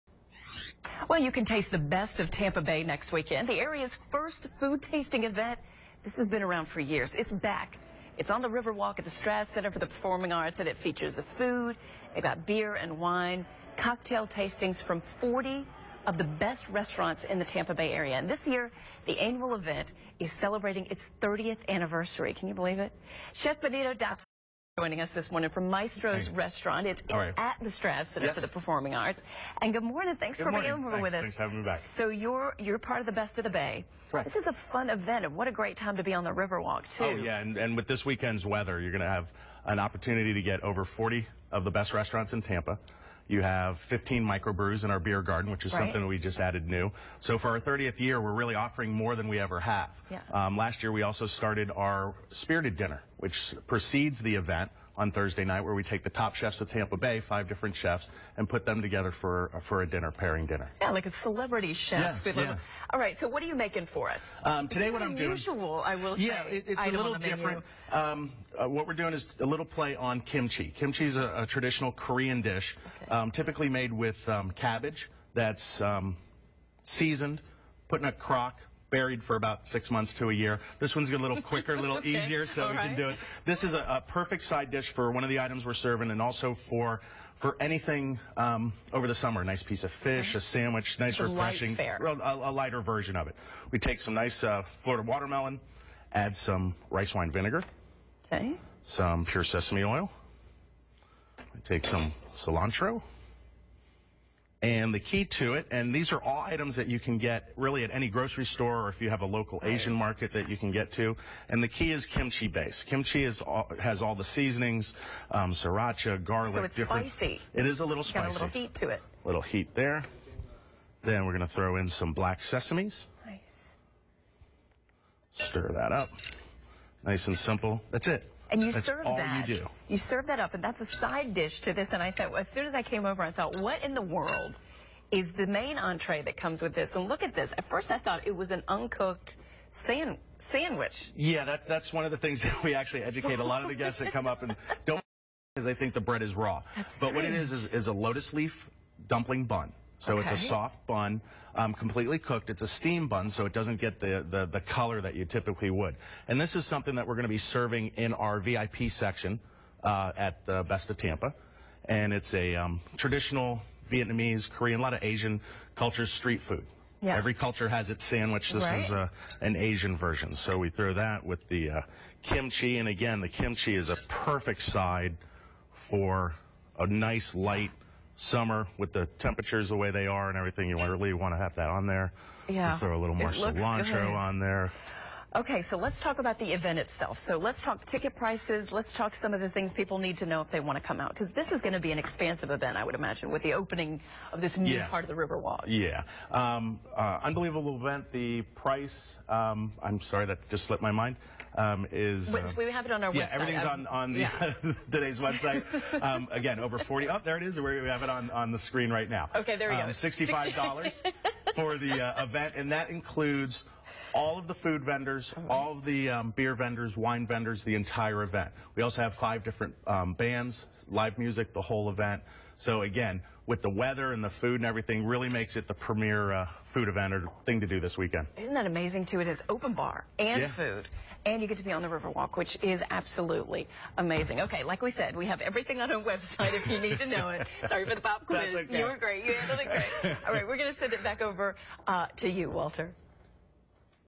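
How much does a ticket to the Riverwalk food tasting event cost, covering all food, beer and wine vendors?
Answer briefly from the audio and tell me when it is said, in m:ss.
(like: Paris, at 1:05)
$65, at 3:29.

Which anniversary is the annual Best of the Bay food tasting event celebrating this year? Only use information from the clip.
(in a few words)
30th.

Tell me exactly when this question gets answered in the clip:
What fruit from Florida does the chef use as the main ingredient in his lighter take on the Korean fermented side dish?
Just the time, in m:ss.
1:35.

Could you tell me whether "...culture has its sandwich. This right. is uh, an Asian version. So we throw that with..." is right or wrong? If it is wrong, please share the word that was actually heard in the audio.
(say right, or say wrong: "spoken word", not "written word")
right.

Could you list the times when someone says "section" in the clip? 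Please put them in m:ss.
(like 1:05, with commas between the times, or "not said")
2:38.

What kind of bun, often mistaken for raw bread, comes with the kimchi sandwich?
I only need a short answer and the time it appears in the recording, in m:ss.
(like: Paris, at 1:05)
lotus leaf dumpling bun, at 2:27.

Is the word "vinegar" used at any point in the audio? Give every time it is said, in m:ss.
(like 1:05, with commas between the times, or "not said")
1:37.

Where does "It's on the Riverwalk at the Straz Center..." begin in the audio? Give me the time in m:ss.
0:08.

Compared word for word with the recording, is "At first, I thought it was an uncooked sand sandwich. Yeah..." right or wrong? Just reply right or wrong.
right.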